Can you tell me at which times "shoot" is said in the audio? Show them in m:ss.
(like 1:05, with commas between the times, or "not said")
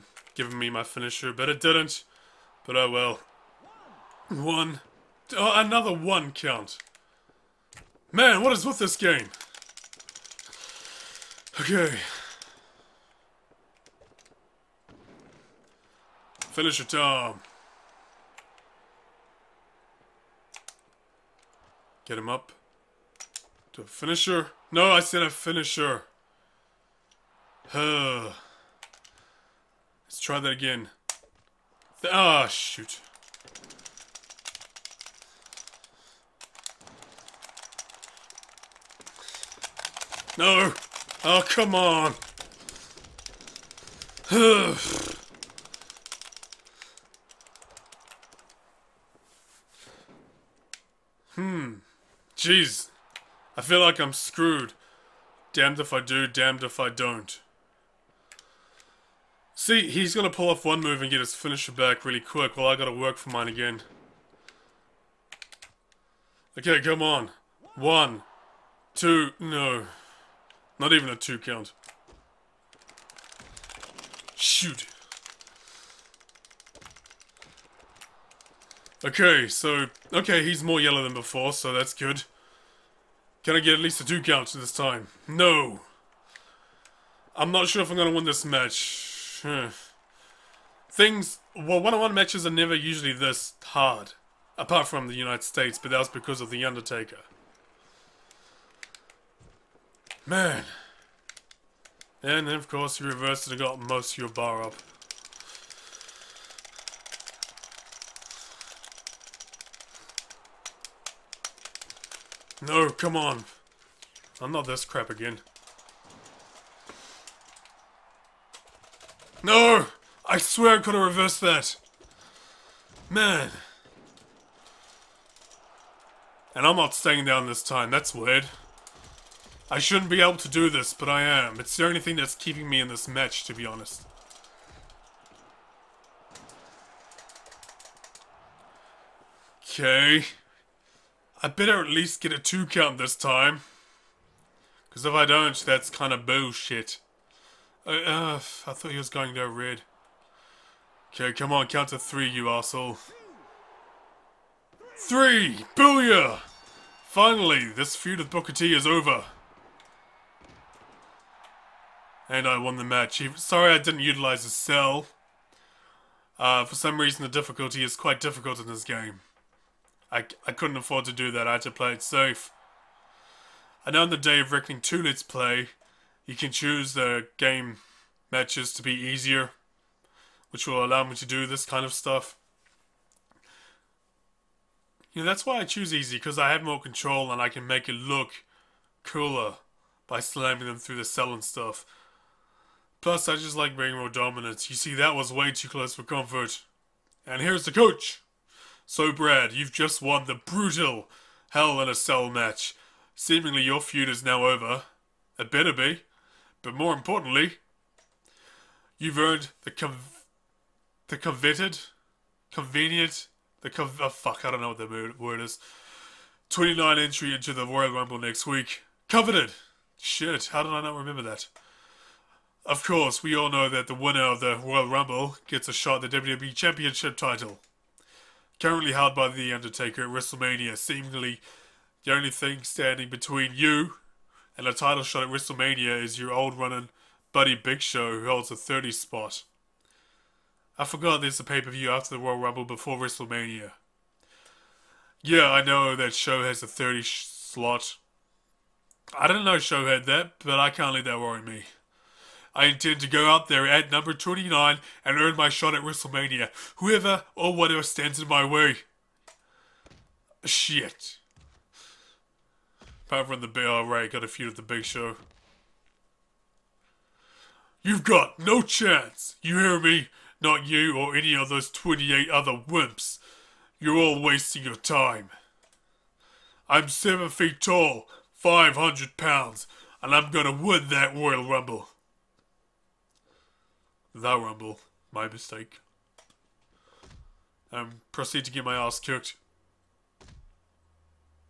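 0:32, 1:14.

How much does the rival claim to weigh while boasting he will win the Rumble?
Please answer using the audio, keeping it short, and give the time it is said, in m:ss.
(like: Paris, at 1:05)
500 pounds, at 4:38.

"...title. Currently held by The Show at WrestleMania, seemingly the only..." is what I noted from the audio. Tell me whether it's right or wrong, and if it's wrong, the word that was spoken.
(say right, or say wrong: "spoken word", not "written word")
wrong: "Undertaker", not "Show".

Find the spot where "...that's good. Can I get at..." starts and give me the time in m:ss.
1:21.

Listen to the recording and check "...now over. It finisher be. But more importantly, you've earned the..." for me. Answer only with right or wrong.
wrong.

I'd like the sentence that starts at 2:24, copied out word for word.
Because if I don't, that's kind of bullshit.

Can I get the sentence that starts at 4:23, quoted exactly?
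Panther and the Big Alright got a feud with the Big Show.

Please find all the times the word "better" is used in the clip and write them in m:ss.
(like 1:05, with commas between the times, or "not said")
2:21, 3:25.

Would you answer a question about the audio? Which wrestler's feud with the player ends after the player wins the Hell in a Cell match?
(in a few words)
Booker T.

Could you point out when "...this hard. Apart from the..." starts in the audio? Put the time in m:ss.
1:33.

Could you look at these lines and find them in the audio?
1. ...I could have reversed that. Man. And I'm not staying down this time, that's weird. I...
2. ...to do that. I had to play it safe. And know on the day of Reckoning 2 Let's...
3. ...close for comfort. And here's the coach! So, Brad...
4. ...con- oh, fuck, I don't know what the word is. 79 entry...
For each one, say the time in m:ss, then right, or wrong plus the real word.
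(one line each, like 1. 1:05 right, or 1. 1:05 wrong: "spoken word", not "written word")
1. 2:00 right
2. 2:51 right
3. 3:15 right
4. 3:33 wrong: "29", not "79".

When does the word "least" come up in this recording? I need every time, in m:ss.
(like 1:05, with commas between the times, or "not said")
1:23, 2:21.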